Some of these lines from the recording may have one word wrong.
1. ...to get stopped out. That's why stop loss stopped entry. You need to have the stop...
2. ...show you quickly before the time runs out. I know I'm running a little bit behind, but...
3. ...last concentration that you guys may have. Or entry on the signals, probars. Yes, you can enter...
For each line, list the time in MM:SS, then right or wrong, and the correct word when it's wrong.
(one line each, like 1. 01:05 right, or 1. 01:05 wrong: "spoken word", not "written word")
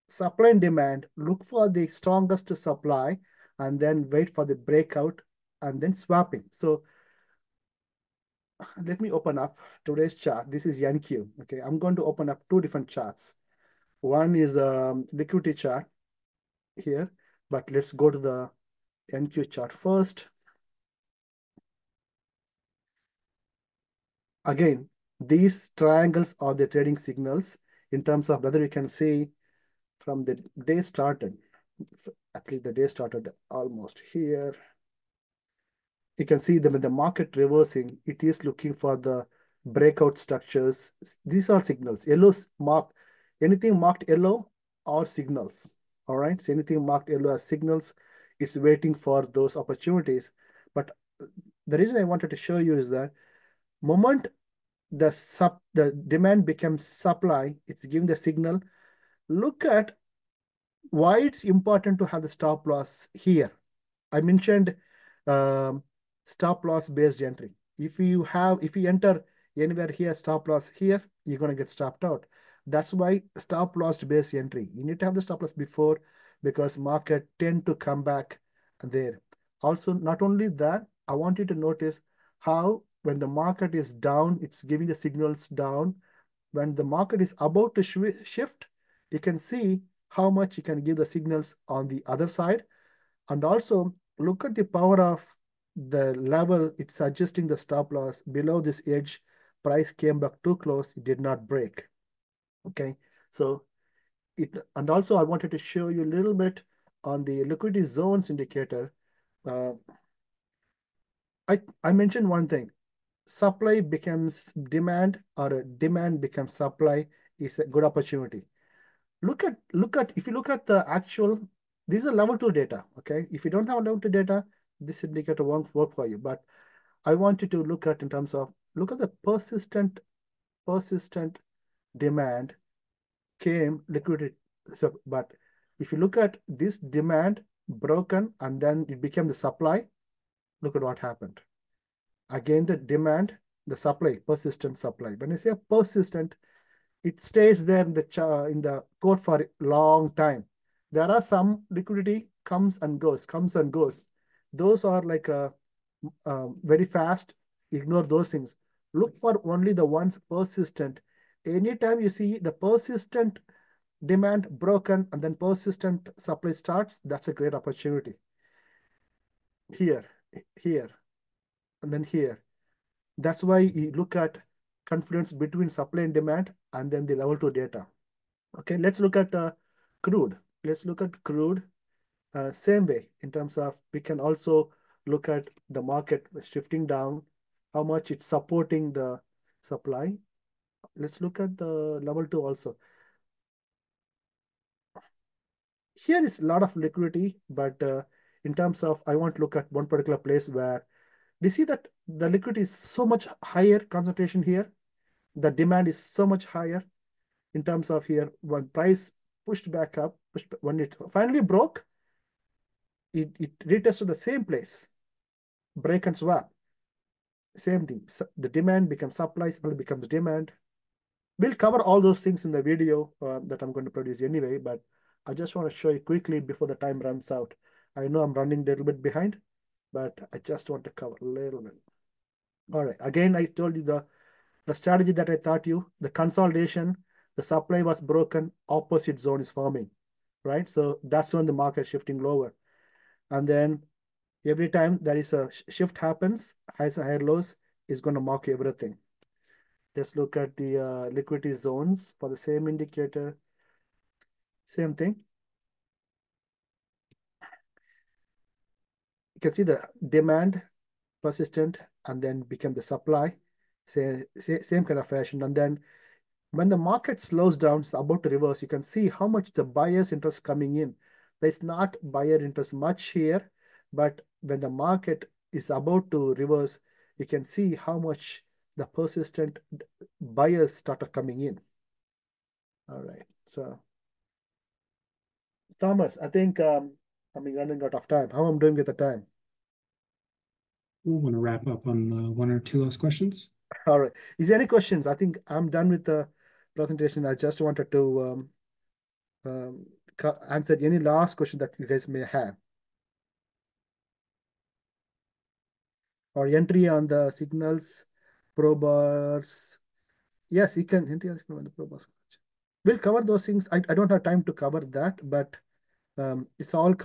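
1. 01:11 wrong: "based", not "stopped"
2. 03:45 right
3. 05:00 wrong: "question", not "concentration".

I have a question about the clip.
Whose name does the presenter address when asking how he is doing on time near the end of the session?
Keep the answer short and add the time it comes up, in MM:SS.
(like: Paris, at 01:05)
Thomas, at 04:45.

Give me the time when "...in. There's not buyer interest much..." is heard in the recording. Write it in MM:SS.
04:30.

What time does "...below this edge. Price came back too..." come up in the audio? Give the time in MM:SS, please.
01:38.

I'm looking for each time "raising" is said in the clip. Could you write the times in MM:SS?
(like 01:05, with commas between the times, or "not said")
not said.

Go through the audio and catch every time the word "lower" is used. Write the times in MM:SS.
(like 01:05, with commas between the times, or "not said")
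04:02.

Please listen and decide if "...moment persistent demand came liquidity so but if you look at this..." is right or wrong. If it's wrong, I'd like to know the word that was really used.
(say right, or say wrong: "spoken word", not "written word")
wrong: "persistent", not "moment".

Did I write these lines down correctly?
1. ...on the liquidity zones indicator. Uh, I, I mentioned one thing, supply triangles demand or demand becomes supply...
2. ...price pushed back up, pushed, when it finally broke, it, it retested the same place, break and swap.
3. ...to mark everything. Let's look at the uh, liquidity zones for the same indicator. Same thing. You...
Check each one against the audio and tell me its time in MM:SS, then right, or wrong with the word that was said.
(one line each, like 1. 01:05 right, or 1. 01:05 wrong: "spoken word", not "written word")
1. 01:47 wrong: "becomes", not "triangles"
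2. 03:28 right
3. 04:08 right.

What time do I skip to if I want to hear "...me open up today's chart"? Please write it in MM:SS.
00:09.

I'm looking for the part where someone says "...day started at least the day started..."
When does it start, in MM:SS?
00:30.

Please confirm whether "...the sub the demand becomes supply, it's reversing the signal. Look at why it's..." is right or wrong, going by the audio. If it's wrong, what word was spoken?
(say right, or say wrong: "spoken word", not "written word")
wrong: "giving", not "reversing".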